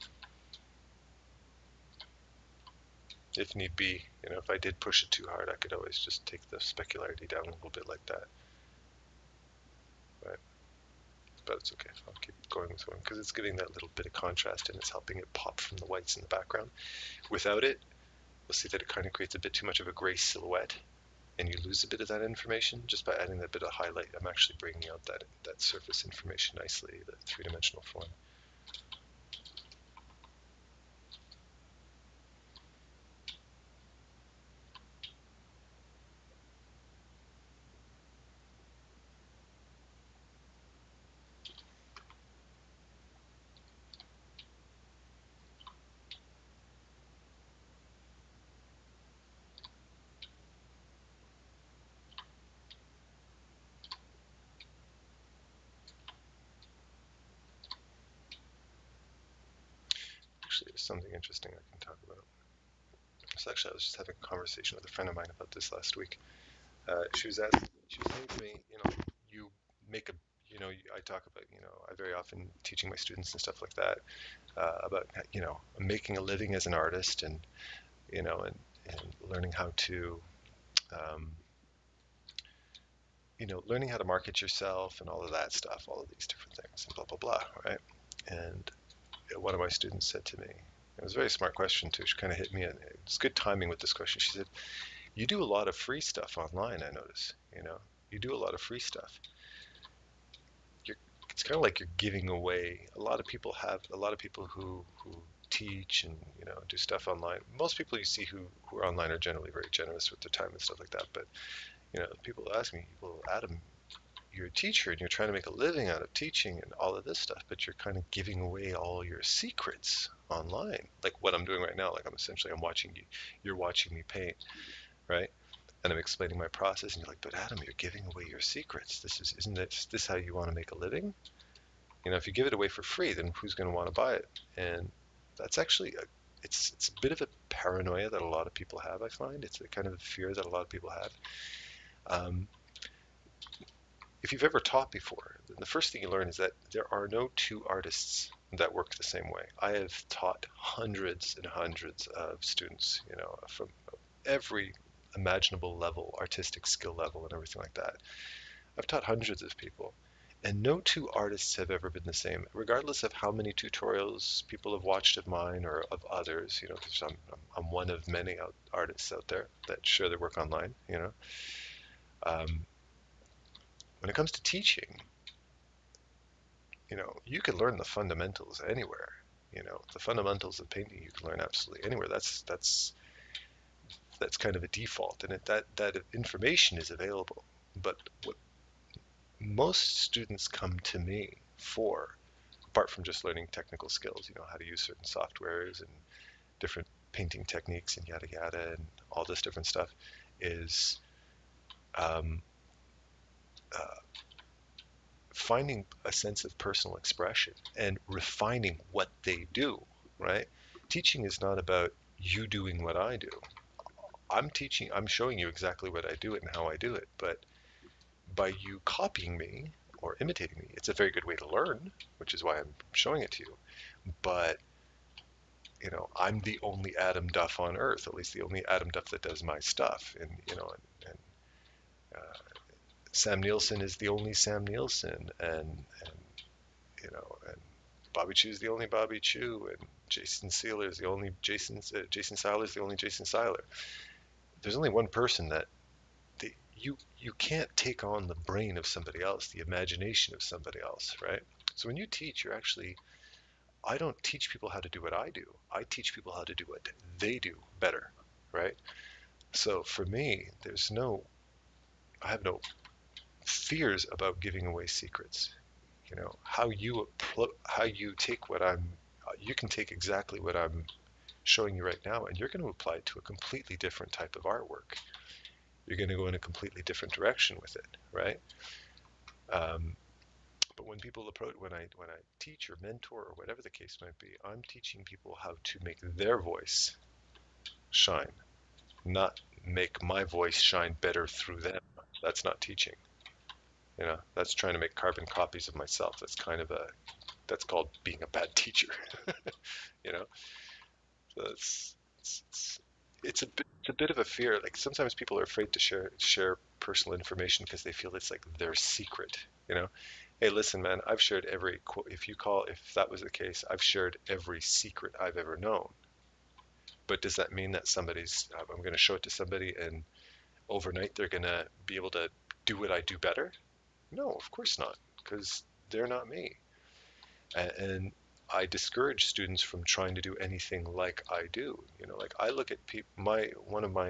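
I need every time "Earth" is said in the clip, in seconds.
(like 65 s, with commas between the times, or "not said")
227 s.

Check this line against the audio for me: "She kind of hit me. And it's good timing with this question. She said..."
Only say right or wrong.
right.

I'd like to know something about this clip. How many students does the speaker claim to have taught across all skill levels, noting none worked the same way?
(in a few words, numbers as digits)
Hundreds and hundreds.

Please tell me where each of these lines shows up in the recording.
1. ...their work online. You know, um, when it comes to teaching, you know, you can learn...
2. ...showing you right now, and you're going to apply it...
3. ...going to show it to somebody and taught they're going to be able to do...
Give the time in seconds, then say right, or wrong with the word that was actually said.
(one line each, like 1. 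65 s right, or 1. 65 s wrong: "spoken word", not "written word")
1. 170 s right
2. 271 s right
3. 318 s wrong: "overnight", not "taught".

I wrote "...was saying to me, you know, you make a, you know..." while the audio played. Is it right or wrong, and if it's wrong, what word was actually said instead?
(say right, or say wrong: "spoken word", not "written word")
right.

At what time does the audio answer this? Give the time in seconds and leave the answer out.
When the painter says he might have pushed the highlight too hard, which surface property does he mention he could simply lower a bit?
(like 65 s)
6 s.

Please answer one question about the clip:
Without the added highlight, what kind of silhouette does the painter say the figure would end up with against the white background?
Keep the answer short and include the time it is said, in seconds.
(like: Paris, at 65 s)
Gray silhouette, at 19 s.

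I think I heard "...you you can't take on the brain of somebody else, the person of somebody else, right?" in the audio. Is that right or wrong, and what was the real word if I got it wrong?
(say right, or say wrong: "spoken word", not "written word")
wrong: "imagination", not "person".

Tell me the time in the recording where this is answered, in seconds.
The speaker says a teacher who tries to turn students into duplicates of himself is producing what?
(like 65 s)
294 s.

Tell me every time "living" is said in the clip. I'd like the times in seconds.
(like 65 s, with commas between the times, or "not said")
76 s, 115 s, 130 s.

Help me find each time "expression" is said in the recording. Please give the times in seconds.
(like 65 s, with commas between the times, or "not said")
206 s.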